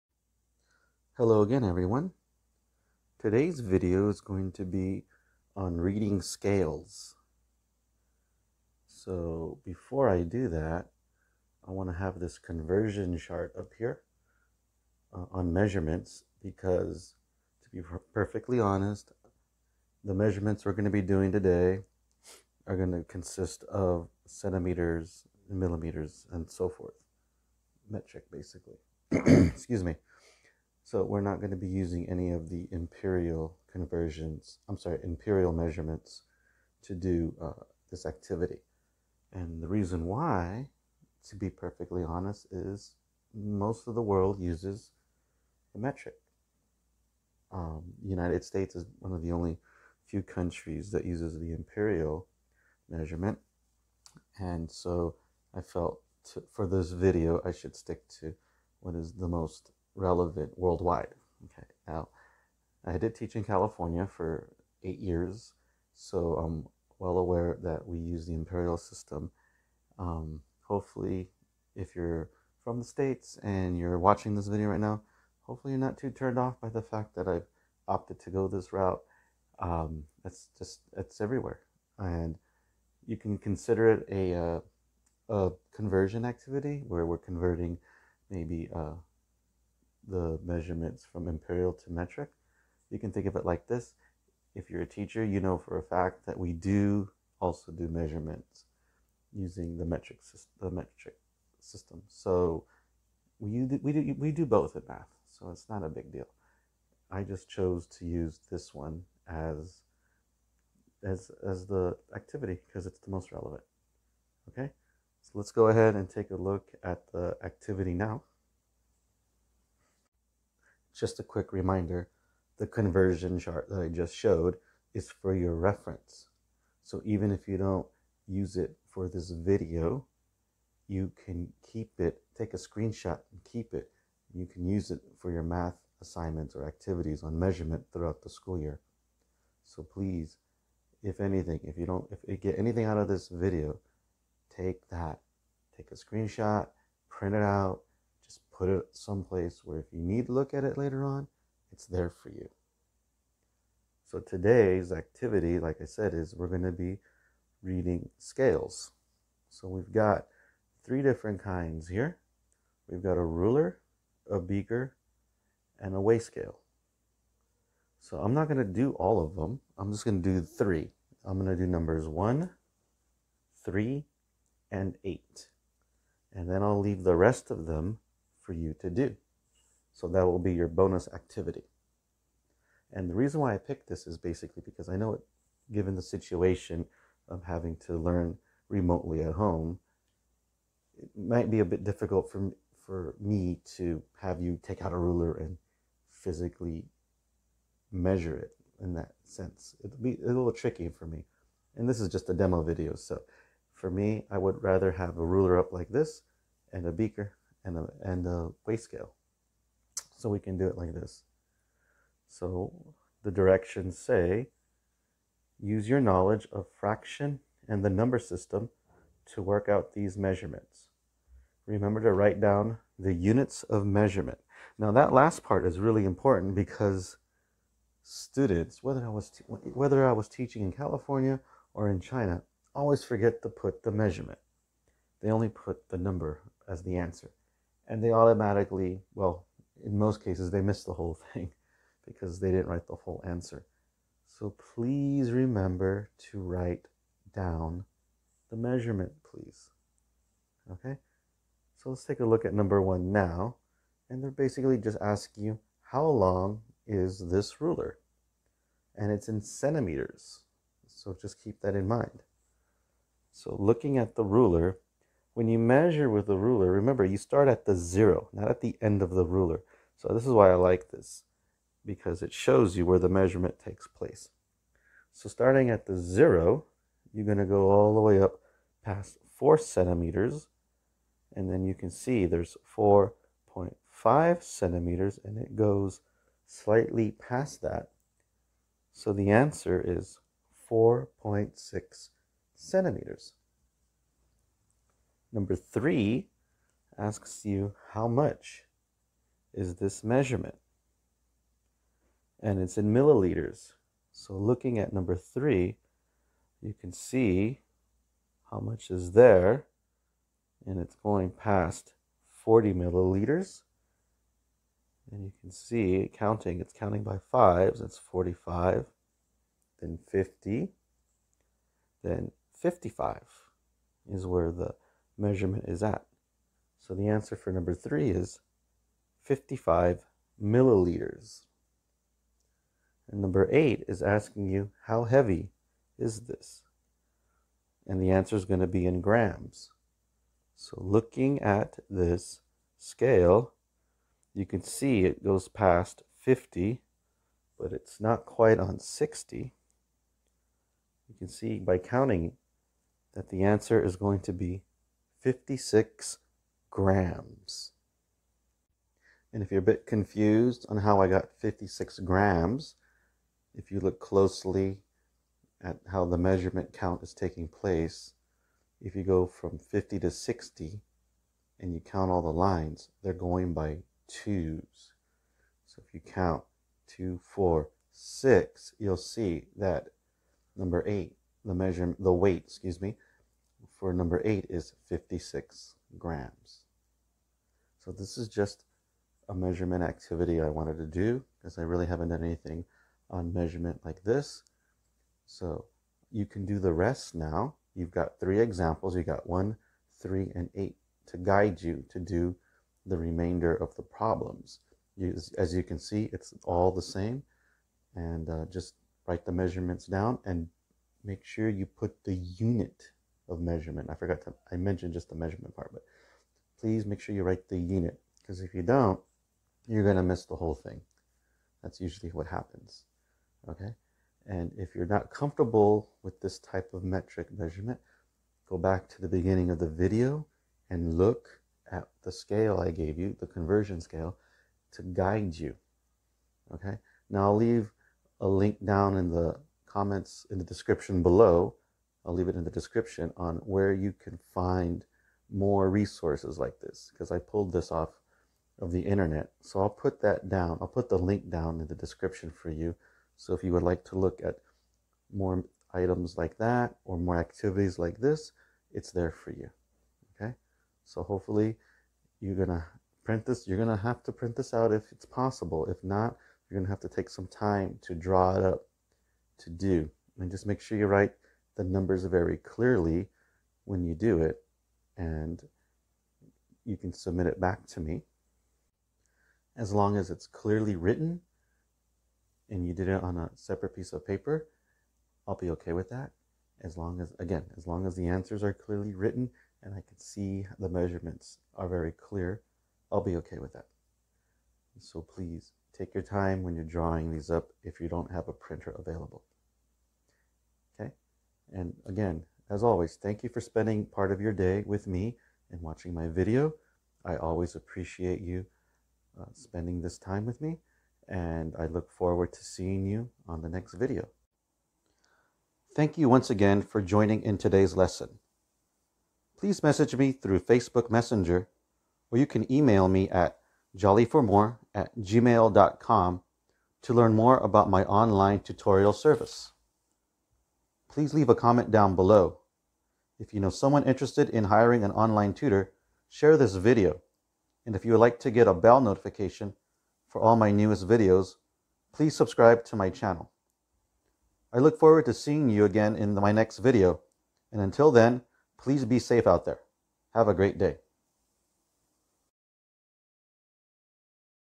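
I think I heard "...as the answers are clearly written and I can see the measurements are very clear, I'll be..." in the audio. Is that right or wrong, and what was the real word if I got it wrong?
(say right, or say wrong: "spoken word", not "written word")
right.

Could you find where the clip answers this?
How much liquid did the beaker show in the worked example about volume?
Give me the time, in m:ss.
5:29.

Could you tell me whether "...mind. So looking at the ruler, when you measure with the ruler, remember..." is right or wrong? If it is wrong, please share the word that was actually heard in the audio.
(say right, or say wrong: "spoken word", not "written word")
right.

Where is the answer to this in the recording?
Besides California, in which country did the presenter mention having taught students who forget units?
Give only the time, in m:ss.
3:51.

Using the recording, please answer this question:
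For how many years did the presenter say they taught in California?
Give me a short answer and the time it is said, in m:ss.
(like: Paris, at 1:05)
8, at 1:04.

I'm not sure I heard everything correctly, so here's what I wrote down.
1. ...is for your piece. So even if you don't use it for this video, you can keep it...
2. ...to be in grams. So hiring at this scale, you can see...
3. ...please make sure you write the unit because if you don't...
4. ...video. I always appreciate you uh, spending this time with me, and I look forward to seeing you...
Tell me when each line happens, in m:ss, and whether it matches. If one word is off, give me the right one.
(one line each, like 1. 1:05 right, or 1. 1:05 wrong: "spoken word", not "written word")
1. 2:04 wrong: "reference", not "piece"
2. 5:38 wrong: "looking", not "hiring"
3. 6:56 right
4. 8:26 right.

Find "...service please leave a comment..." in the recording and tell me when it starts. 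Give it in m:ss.
8:48.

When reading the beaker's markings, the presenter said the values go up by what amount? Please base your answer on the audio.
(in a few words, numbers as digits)
5.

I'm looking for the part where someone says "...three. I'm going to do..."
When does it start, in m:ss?
2:50.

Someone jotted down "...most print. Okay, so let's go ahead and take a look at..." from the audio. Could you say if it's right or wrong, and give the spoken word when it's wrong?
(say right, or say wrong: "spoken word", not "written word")
wrong: "relevant", not "print".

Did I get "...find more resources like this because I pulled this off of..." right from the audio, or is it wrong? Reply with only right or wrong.
right.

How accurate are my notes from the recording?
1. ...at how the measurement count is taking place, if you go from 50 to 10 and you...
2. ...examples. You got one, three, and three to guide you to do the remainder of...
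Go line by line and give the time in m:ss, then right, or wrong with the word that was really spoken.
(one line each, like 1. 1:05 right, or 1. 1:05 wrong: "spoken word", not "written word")
1. 6:05 wrong: "60", not "10"
2. 6:38 wrong: "eight", not "three".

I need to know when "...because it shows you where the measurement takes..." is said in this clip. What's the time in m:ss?
4:31.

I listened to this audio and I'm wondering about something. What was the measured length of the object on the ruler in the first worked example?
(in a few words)
4.6 centimeters.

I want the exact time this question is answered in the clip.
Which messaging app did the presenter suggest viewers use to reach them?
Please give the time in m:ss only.
8:40.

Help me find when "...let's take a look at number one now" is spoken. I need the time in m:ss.
4:11.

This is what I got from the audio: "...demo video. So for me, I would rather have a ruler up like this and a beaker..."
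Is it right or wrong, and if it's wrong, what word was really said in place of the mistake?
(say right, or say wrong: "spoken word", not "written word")
right.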